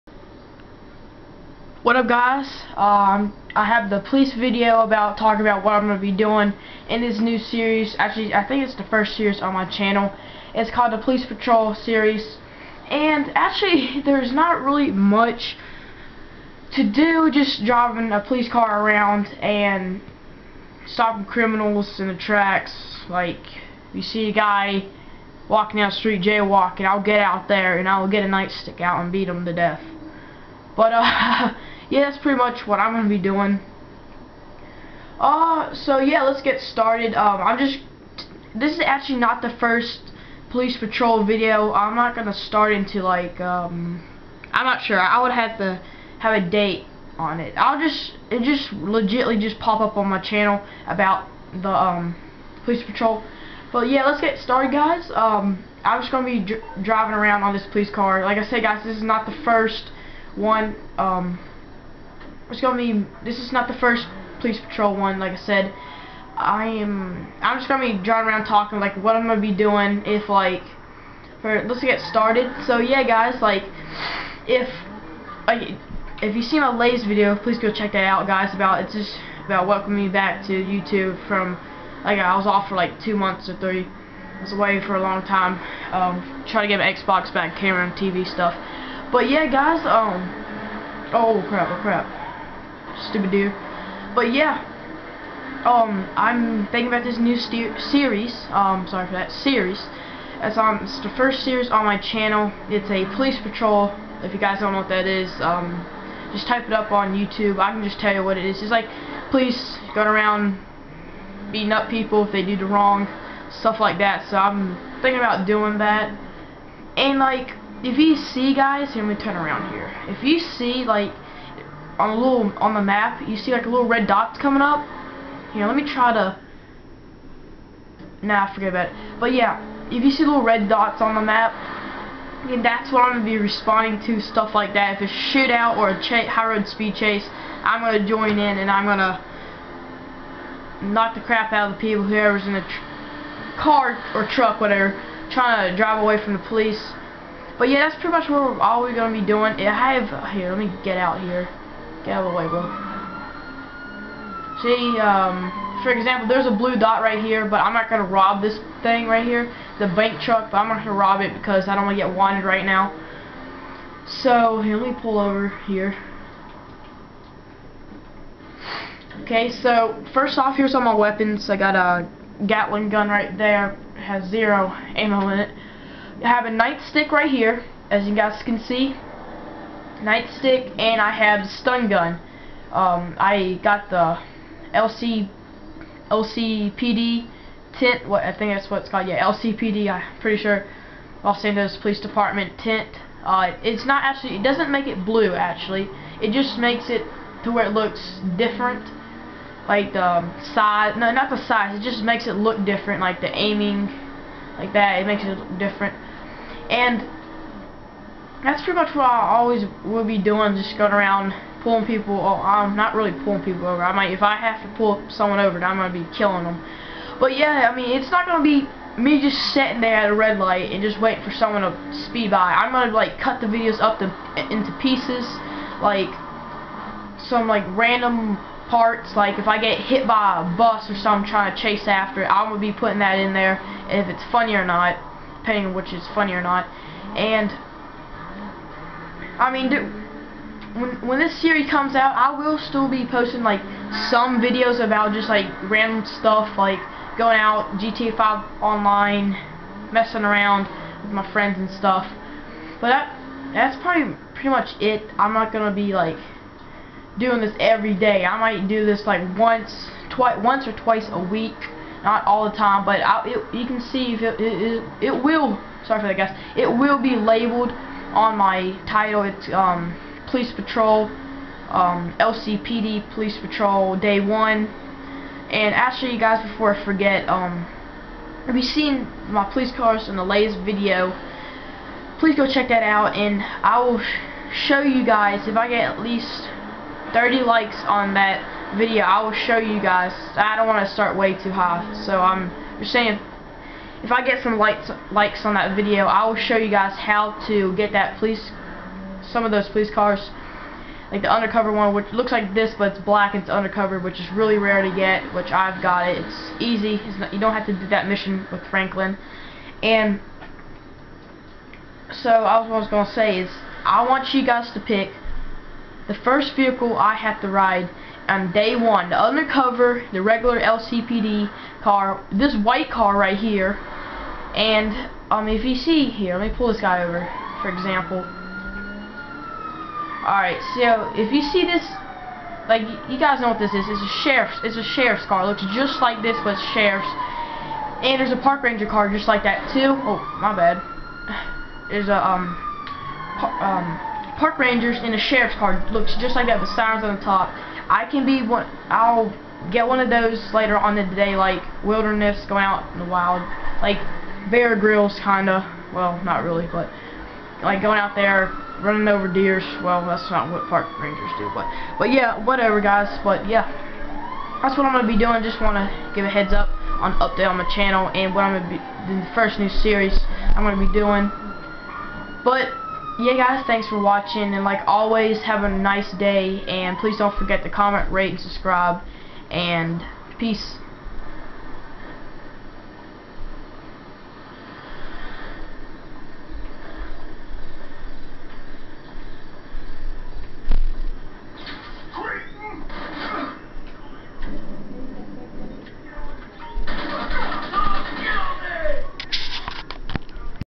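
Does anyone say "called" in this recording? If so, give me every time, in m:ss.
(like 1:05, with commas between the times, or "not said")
0:10, 3:08.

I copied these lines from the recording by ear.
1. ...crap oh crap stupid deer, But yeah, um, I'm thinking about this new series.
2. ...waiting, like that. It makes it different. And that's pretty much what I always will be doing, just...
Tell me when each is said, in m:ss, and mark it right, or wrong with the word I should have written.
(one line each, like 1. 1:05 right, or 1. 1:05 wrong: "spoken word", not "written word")
1. 1:31 right
2. 3:23 wrong: "aiming", not "waiting".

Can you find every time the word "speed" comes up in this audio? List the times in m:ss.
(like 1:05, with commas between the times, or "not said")
2:16, 3:42.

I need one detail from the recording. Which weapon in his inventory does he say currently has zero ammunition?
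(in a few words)
Gatling gun.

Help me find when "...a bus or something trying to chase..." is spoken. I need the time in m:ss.
3:50.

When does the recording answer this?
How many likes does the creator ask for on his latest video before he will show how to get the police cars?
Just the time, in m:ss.
4:47.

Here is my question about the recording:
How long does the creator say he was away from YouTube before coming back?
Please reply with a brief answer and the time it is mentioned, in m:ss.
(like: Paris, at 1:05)
two months or three, at 1:23.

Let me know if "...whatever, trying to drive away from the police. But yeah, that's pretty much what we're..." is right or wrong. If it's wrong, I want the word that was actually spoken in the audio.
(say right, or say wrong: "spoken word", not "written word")
right.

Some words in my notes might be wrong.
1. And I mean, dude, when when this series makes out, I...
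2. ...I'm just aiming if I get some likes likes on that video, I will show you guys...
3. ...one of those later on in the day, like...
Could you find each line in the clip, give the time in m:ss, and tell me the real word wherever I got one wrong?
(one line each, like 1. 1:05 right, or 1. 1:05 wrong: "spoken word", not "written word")
1. 3:57 wrong: "comes", not "makes"
2. 4:52 wrong: "saying", not "aiming"
3. 5:49 right.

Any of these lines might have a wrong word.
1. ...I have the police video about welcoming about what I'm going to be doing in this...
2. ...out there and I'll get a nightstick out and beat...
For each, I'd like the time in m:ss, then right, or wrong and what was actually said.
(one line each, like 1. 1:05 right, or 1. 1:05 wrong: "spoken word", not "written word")
1. 0:03 wrong: "talking", not "welcoming"
2. 0:27 right.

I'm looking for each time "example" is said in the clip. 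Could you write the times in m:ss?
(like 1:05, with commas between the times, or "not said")
2:35, 5:27.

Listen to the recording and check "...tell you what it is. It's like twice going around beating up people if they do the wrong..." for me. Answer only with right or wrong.
wrong.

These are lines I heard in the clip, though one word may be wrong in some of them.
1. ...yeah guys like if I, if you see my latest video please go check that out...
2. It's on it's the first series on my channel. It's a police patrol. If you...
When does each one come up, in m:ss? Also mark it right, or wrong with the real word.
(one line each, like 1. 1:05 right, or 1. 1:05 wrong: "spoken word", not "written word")
1. 1:12 right
2. 1:40 right.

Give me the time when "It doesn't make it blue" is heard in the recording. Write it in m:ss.
3:14.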